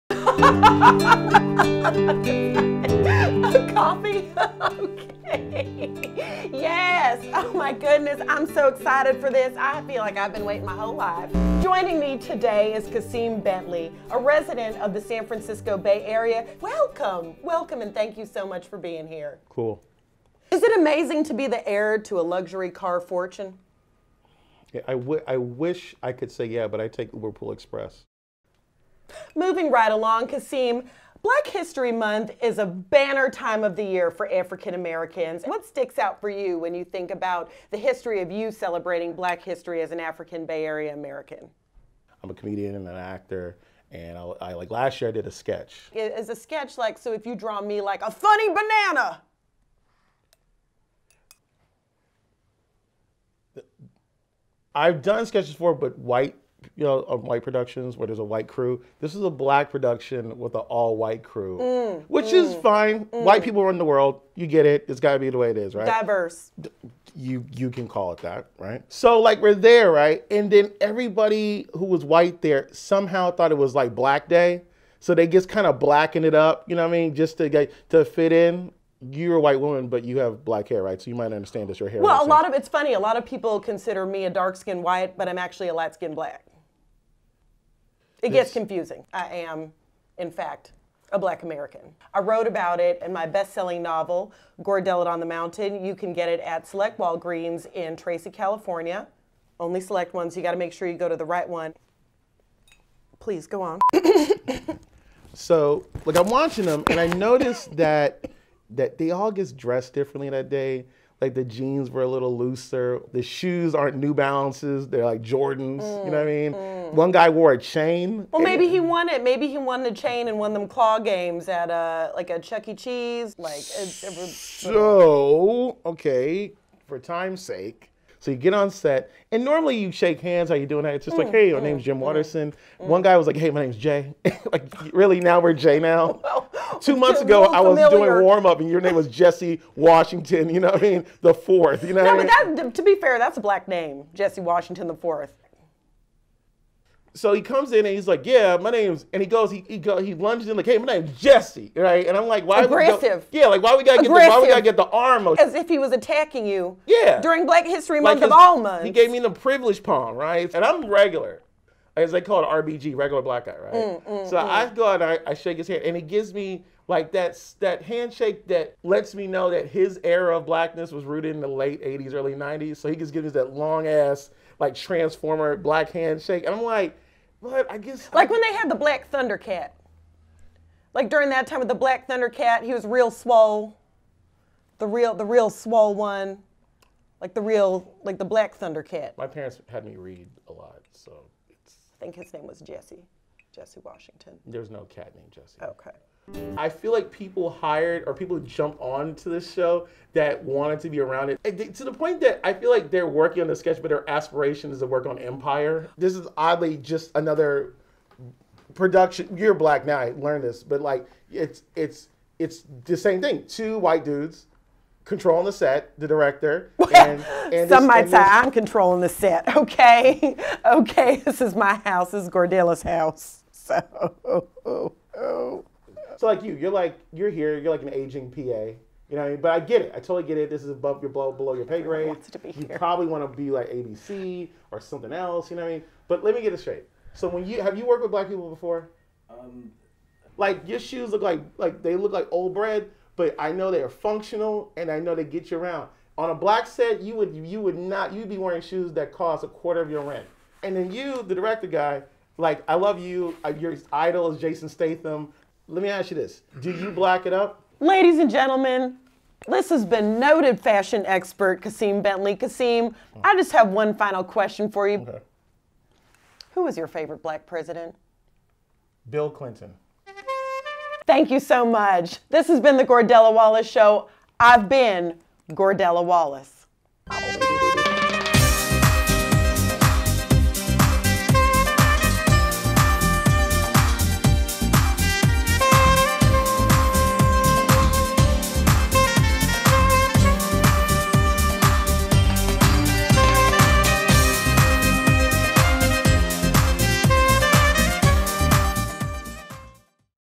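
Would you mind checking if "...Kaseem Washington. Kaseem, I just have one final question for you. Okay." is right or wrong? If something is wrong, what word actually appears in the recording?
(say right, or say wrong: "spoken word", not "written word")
wrong: "Bentley", not "Washington".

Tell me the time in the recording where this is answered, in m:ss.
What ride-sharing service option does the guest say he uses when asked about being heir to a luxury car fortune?
0:27.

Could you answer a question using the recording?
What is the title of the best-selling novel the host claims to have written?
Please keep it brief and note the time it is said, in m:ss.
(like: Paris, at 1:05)
Gordellet on the Mountain, at 1:34.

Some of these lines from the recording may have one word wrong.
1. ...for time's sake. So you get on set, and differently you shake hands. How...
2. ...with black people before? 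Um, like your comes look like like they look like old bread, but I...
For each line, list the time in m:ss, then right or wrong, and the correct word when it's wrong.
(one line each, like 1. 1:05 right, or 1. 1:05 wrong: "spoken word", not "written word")
1. 2:06 wrong: "normally", not "differently"
2. 3:58 wrong: "shoes", not "comes".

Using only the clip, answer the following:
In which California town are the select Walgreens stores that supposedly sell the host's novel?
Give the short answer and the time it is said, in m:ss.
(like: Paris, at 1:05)
Tracy, at 1:37.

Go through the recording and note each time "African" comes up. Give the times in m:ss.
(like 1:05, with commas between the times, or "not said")
0:34, 0:39.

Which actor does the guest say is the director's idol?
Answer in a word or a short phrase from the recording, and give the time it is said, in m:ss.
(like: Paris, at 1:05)
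Jason Statham, at 4:14.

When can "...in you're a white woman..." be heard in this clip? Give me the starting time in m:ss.
1:18.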